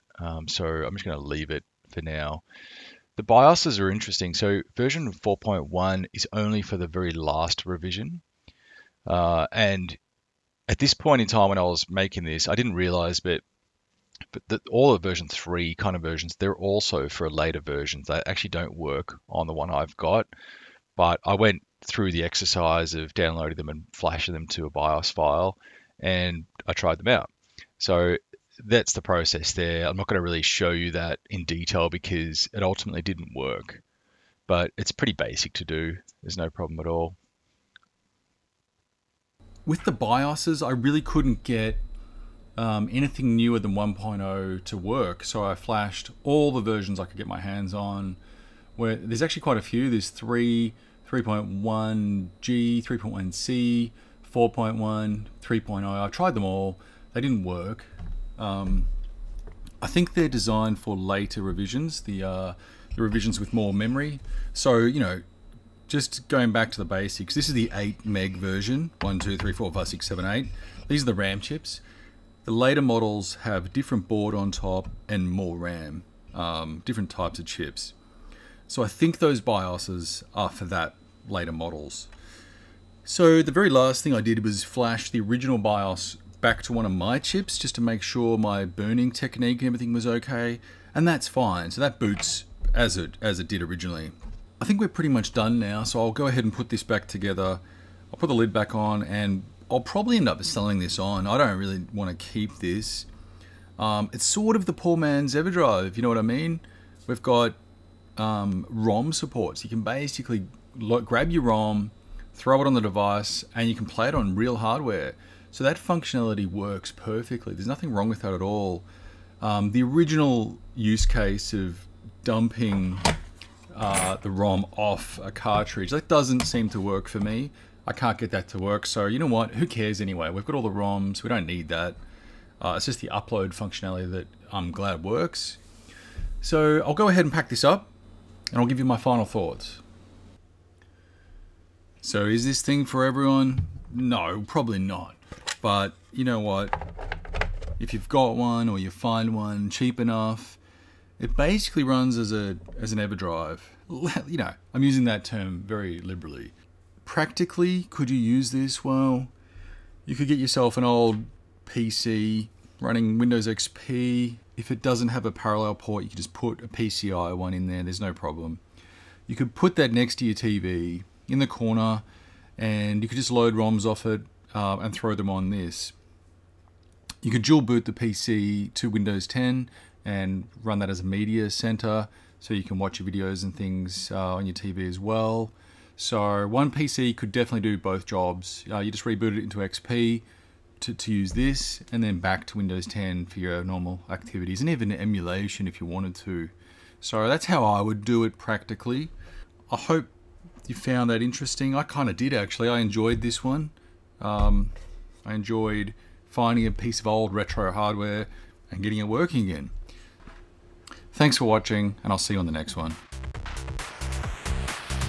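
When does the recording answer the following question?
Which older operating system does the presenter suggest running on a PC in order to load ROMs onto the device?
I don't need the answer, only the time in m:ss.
2:43.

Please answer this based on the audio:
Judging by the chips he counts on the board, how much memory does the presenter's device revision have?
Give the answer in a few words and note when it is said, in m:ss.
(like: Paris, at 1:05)
8 MB, at 1:07.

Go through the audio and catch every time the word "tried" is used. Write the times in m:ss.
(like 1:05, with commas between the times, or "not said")
0:26, 0:56.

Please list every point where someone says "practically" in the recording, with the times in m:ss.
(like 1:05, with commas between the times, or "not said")
2:37, 3:18.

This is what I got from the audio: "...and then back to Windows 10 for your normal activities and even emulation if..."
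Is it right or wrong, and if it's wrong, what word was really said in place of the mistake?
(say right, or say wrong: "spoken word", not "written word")
right.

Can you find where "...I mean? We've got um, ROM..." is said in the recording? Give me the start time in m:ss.
1:46.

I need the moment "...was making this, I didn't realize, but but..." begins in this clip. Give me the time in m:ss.
0:11.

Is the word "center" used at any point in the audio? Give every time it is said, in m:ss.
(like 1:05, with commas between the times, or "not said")
3:01.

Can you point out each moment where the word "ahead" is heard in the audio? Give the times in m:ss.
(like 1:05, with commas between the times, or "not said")
1:36, 2:17.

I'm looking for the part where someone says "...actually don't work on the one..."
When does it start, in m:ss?
0:18.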